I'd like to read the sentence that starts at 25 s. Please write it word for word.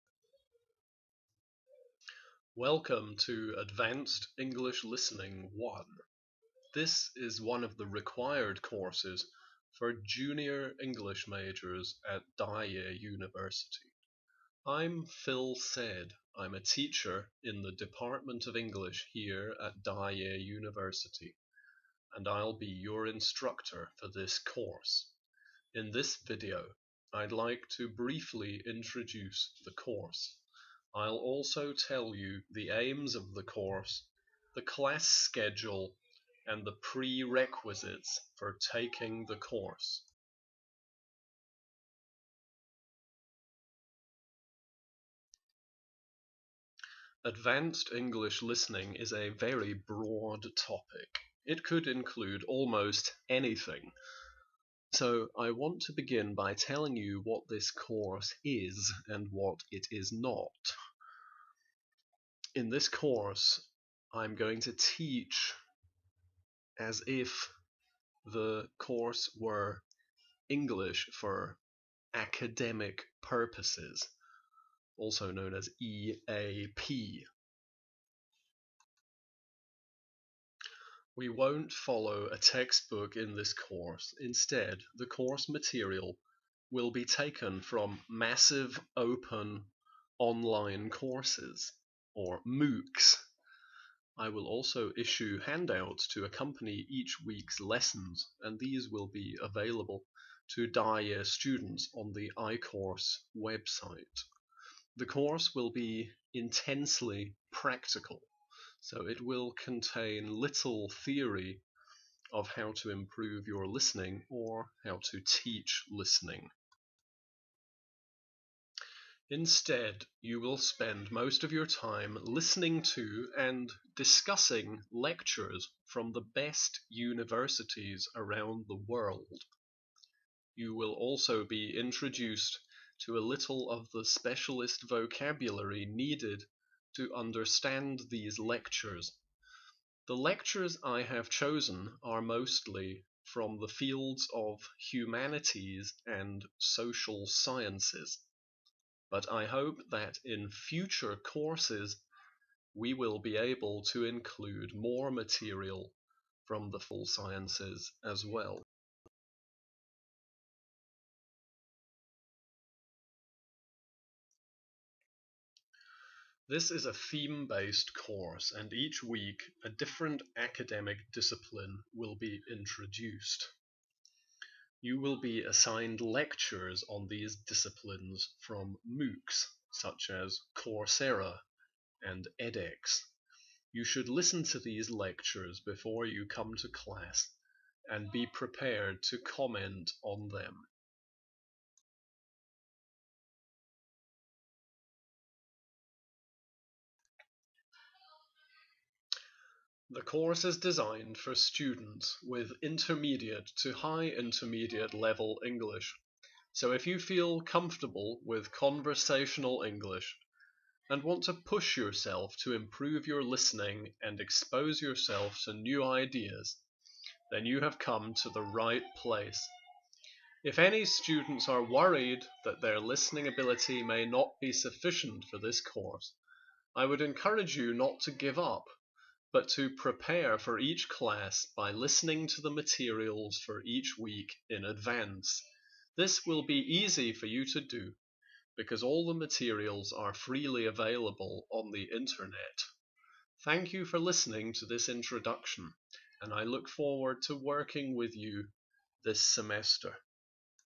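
In this video, I'd like to briefly introduce the course.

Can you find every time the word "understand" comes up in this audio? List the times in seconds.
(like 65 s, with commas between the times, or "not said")
137 s.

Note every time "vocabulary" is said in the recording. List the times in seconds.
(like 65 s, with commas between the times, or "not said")
134 s.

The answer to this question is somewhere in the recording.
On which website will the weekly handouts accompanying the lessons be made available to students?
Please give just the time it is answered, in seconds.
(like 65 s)
102 s.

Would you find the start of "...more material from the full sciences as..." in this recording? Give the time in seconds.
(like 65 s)
154 s.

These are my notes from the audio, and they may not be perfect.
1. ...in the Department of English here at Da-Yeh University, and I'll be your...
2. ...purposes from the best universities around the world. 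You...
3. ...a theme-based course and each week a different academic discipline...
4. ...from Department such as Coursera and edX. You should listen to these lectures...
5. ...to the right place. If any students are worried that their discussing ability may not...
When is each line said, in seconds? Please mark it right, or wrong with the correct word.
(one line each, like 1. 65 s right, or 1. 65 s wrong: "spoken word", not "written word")
1. 17 s right
2. 124 s wrong: "lectures", not "purposes"
3. 166 s right
4. 178 s wrong: "MOOCs", not "Department"
5. 218 s wrong: "listening", not "discussing".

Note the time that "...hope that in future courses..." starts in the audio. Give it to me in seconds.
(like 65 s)
149 s.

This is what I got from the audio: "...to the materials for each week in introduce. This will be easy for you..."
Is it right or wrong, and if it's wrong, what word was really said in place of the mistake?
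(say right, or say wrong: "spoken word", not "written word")
wrong: "advance", not "introduce".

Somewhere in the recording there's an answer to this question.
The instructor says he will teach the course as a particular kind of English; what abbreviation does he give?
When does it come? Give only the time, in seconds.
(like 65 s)
75 s.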